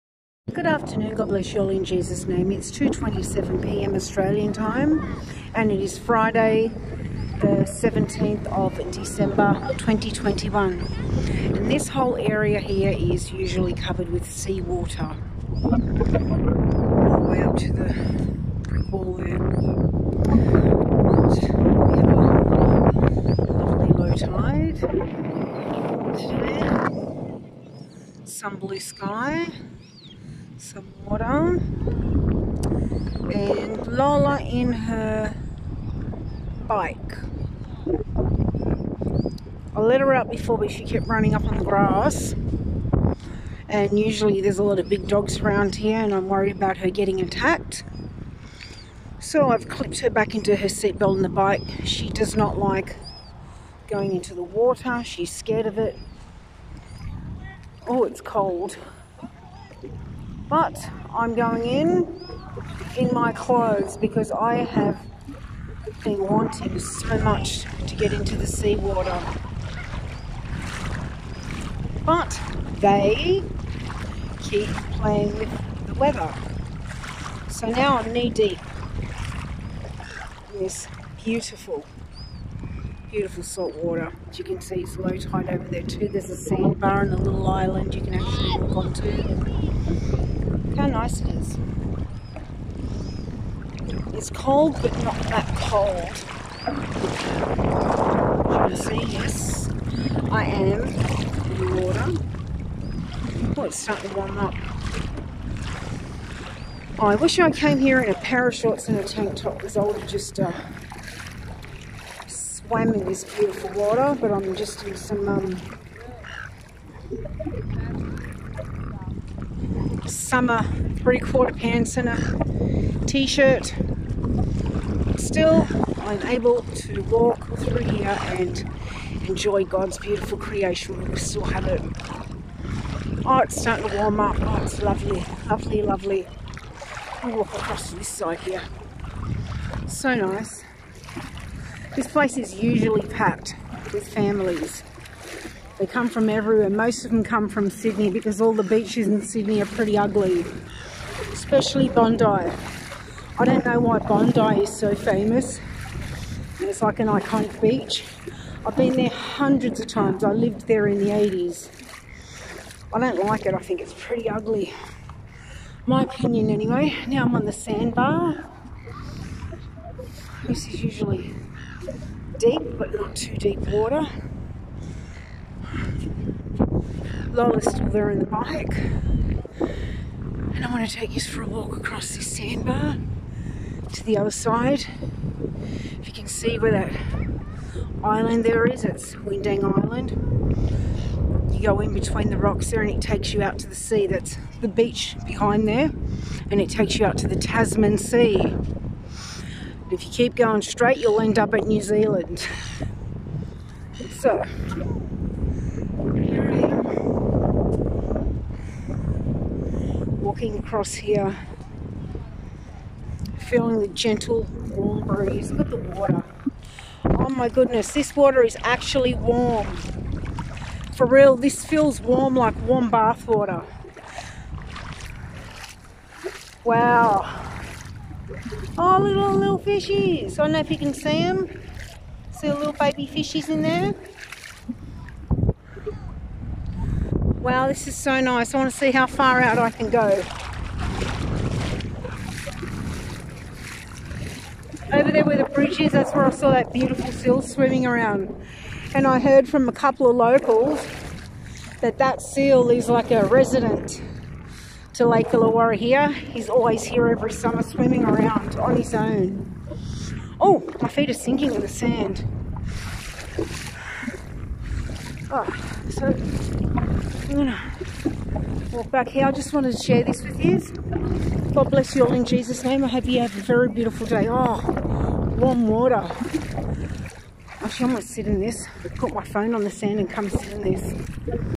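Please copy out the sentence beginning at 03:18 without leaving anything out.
And if you keep going straight, you'll end up at New Zealand.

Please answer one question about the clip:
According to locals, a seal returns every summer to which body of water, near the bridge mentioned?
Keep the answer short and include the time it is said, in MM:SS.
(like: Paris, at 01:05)
Lake Illawarra, at 04:15.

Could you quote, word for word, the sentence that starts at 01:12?
But they keep playing with the weather.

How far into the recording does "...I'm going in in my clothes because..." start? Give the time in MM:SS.
01:01.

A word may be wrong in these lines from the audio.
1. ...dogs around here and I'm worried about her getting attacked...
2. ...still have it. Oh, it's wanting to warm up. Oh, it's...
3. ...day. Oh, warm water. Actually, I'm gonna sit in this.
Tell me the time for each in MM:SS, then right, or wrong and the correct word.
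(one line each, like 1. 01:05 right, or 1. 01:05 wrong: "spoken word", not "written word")
1. 00:45 right
2. 02:11 wrong: "starting", not "wanting"
3. 04:34 right.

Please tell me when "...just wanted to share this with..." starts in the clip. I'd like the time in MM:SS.
04:29.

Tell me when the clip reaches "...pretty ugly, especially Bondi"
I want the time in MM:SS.
02:29.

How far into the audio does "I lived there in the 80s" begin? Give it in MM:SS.
02:40.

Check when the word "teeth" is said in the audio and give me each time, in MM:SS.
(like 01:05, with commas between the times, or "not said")
not said.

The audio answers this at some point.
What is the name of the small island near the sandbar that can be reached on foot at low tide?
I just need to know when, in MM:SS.
03:09.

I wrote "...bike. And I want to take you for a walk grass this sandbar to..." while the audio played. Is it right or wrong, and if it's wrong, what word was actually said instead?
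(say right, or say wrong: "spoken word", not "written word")
wrong: "across", not "grass".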